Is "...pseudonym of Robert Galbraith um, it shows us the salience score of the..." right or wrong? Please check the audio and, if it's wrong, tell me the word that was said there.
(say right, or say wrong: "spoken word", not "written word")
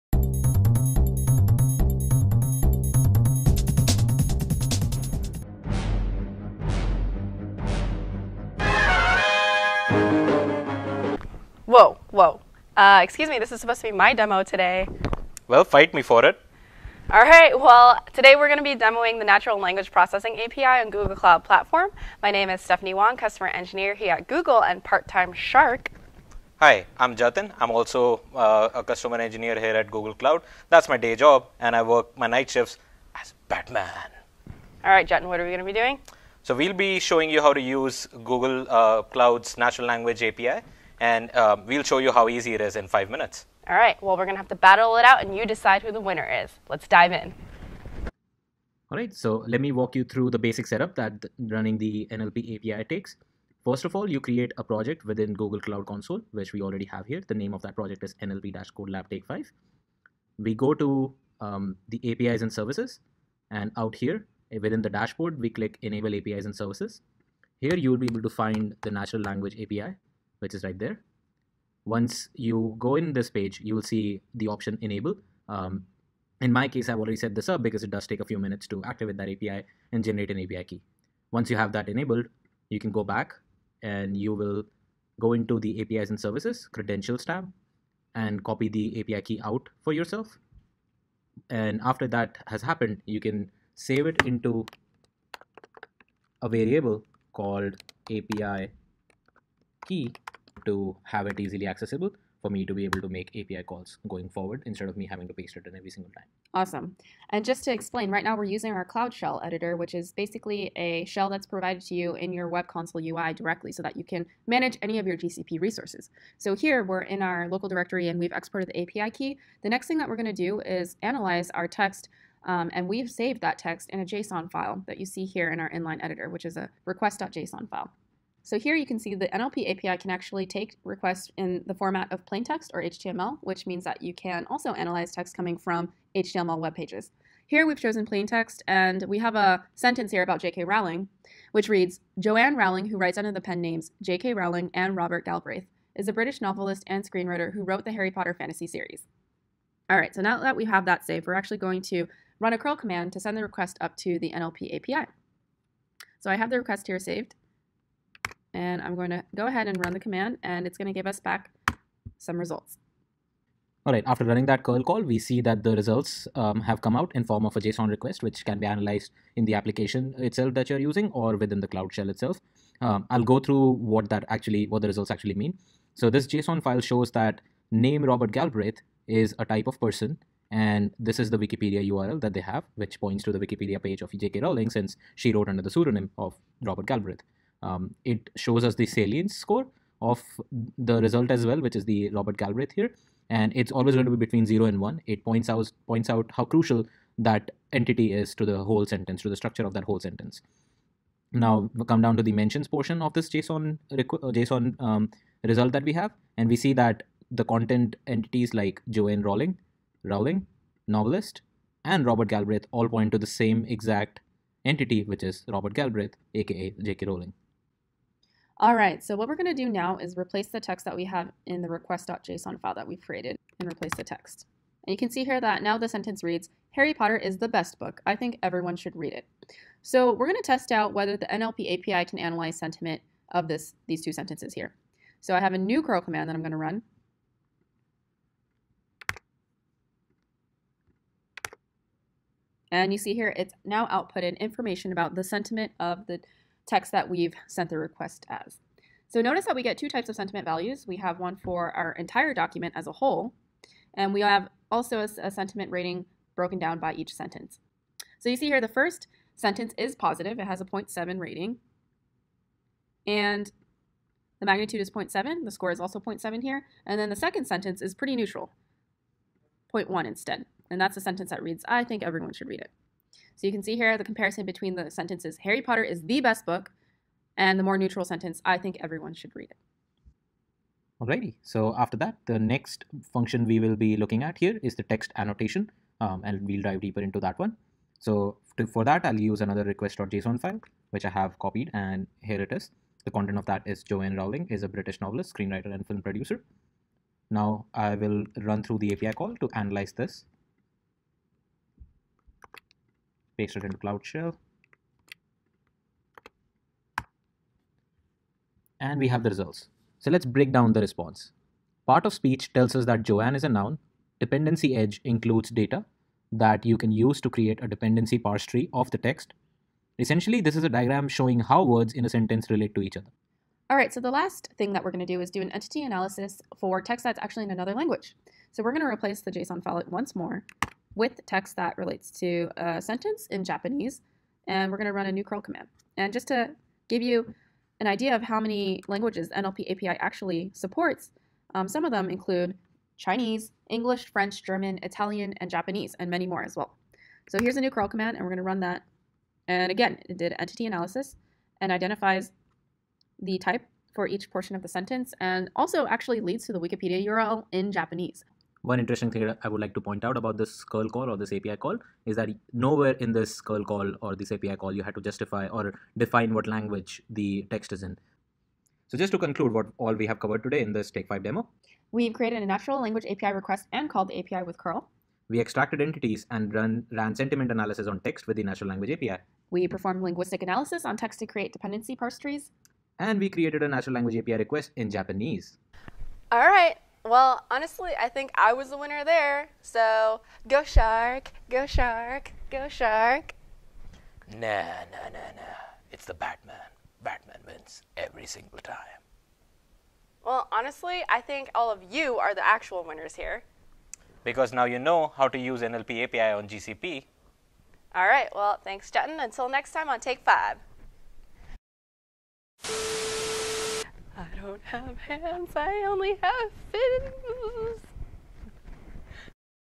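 right.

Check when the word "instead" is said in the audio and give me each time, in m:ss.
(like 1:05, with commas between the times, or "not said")
1:44, 4:30.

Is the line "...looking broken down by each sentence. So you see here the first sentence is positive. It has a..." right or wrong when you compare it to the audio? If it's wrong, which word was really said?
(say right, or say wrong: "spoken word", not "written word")
wrong: "rating", not "looking".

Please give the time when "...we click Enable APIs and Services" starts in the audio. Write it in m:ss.
1:05.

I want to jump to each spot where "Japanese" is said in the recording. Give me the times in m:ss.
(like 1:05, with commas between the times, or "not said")
5:33, 5:45, 5:57, 6:24.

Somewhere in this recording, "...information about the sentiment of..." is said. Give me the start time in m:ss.
4:04.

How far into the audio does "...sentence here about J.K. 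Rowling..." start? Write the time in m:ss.
2:19.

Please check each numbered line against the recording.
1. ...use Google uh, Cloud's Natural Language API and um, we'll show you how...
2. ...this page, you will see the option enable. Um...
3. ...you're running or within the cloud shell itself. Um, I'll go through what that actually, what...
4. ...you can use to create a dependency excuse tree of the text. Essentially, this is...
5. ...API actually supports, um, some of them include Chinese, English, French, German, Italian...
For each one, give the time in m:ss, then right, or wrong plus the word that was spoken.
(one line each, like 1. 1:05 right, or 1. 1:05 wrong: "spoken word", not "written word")
1. 0:37 right
2. 1:13 right
3. 2:50 wrong: "using", not "running"
4. 5:16 wrong: "parse", not "excuse"
5. 5:39 right.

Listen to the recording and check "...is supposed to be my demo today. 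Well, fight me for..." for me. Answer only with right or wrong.
right.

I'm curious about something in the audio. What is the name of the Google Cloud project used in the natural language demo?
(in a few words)
NLP-Code Lab Take 5.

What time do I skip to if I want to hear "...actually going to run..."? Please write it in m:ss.
2:31.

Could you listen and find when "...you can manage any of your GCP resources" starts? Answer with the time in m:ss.
1:53.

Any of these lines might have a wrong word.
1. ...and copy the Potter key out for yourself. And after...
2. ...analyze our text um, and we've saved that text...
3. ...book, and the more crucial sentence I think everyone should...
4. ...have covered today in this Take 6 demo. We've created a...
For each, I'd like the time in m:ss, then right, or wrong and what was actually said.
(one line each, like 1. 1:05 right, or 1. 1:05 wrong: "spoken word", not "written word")
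1. 1:28 wrong: "API", not "Potter"
2. 2:01 right
3. 4:36 wrong: "neutral", not "crucial"
4. 6:10 wrong: "5", not "6".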